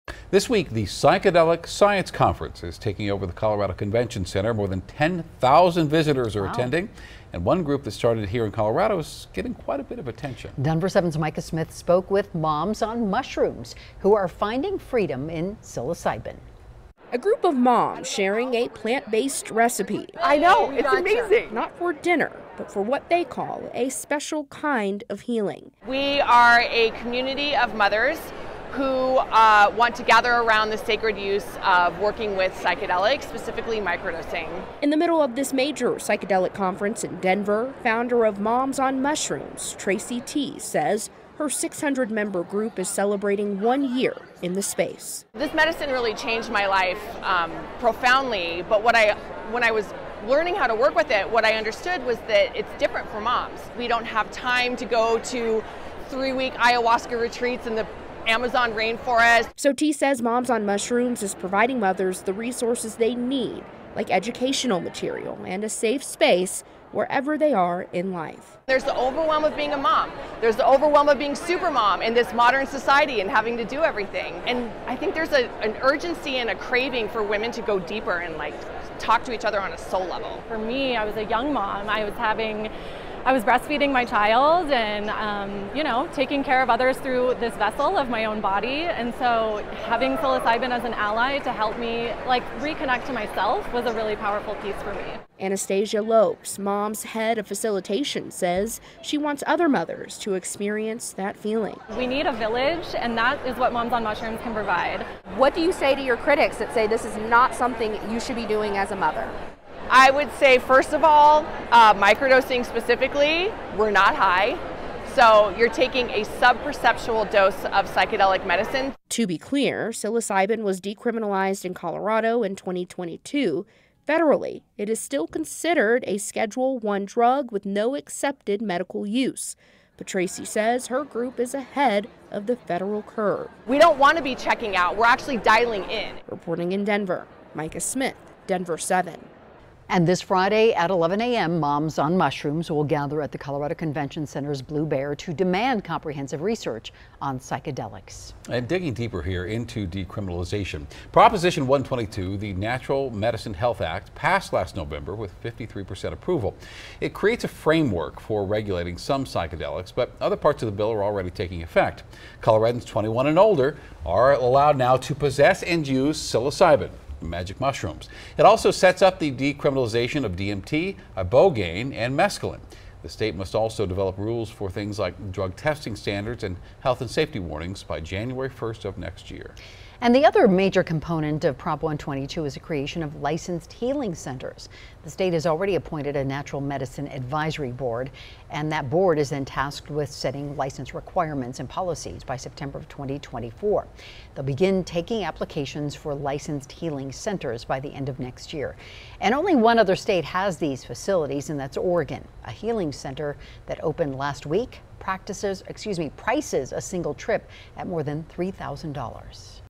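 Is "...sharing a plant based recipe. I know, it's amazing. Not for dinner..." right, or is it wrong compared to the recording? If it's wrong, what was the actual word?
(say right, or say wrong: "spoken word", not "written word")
right.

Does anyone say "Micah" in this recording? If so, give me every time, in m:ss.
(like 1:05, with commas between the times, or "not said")
0:11, 2:17.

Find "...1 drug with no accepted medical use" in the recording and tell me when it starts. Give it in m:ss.
2:06.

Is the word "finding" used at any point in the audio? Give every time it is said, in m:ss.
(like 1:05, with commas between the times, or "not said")
0:14.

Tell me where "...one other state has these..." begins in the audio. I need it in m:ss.
3:19.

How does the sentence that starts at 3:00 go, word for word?
And the other major component of Prop 122 is the creation of licensed healing centers.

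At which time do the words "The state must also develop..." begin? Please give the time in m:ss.
2:53.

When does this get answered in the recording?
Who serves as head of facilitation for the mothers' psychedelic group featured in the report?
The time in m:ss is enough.
1:35.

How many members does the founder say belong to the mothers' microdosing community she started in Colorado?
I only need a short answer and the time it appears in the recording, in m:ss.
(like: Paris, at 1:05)
600, at 0:41.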